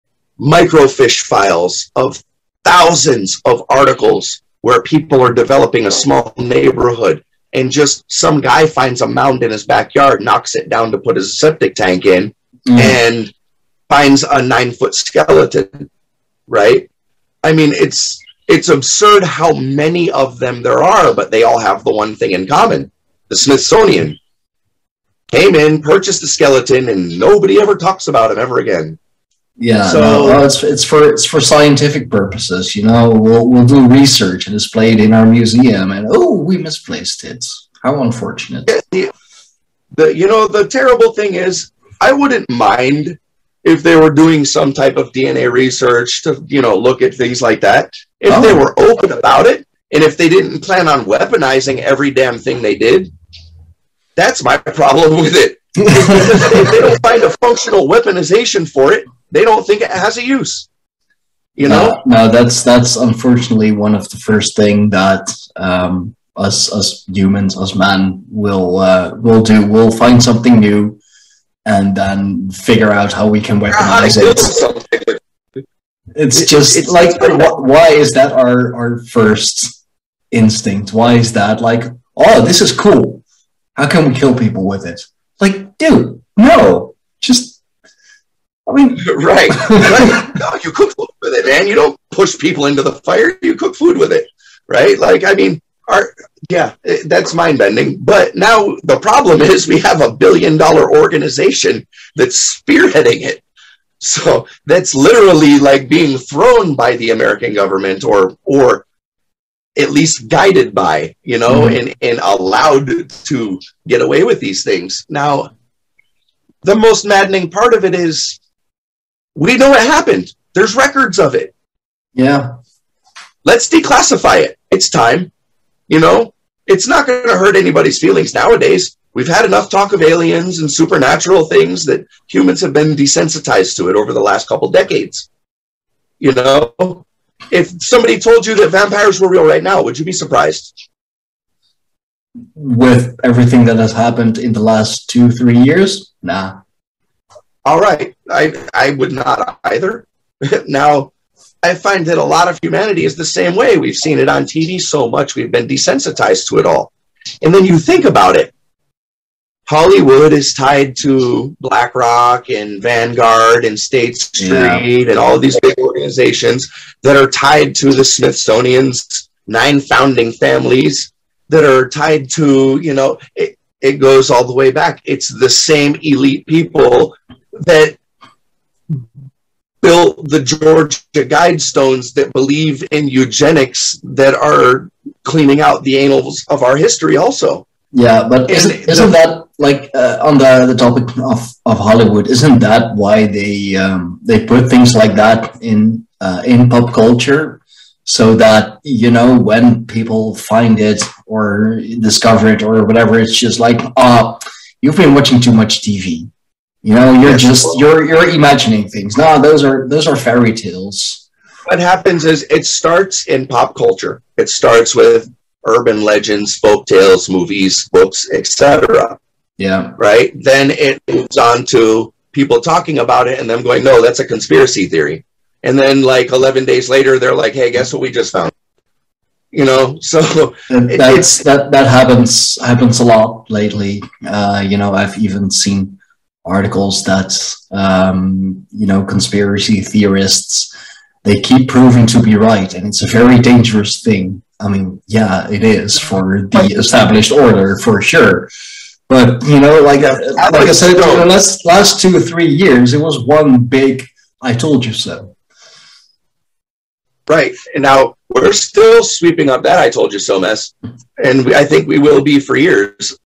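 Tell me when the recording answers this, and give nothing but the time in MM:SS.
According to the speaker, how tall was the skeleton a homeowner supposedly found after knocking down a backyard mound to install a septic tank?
00:14.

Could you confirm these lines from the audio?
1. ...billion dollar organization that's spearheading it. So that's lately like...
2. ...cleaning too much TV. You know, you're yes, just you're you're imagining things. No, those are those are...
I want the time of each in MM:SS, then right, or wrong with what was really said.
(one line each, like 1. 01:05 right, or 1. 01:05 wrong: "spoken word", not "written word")
1. 01:40 wrong: "literally", not "lately"
2. 03:25 wrong: "watching", not "cleaning".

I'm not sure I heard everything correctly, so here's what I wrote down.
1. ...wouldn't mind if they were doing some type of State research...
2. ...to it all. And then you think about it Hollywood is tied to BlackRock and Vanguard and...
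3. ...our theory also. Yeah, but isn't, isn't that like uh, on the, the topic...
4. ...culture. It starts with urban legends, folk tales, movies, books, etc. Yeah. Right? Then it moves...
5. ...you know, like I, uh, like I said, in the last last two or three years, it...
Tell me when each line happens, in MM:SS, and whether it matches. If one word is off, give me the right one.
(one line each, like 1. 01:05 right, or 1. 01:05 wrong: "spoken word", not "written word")
1. 00:42 wrong: "DNA", not "State"
2. 02:36 right
3. 03:06 wrong: "history", not "theory"
4. 03:33 right
5. 04:09 right.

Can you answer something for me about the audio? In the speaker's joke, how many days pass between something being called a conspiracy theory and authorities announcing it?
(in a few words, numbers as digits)
11.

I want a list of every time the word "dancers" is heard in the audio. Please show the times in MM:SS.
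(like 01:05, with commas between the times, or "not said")
not said.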